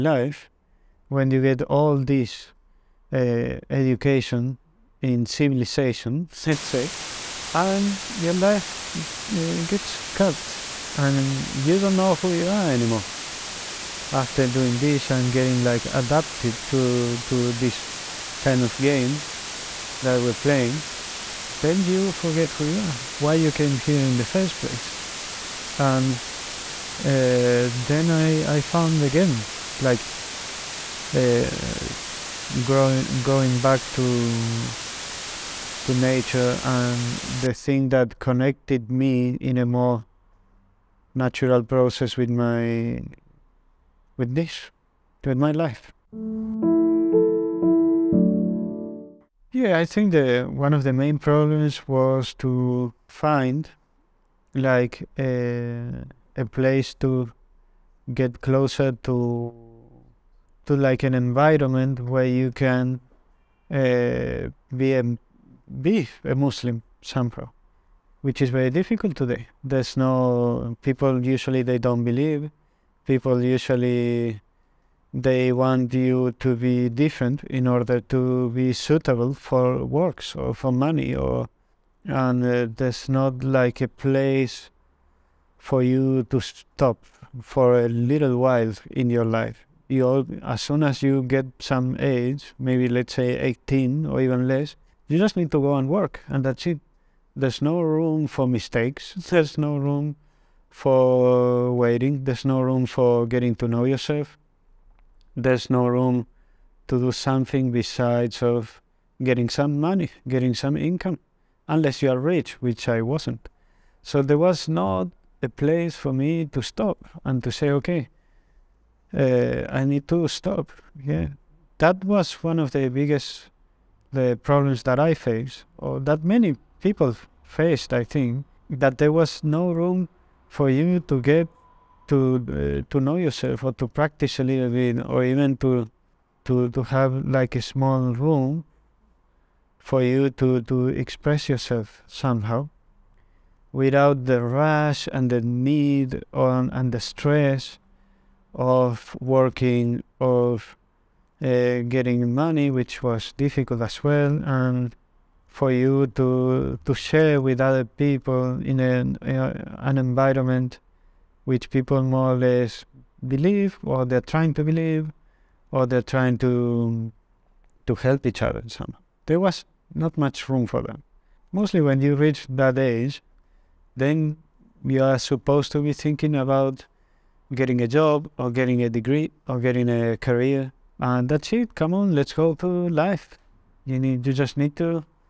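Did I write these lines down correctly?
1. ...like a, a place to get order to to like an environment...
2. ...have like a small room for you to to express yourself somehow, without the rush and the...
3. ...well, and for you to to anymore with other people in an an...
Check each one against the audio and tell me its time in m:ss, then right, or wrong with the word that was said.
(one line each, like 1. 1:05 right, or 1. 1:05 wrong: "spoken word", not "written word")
1. 0:54 wrong: "closer", not "order"
2. 2:16 right
3. 2:34 wrong: "share", not "anymore".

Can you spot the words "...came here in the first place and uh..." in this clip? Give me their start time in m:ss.
0:23.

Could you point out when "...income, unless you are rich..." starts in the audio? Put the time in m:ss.
1:50.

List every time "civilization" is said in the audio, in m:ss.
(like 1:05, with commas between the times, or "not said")
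0:05.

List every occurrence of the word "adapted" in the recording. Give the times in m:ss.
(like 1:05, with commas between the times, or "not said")
0:15.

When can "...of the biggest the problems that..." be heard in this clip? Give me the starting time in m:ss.
2:02.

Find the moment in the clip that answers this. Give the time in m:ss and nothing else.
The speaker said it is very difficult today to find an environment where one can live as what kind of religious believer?
1:06.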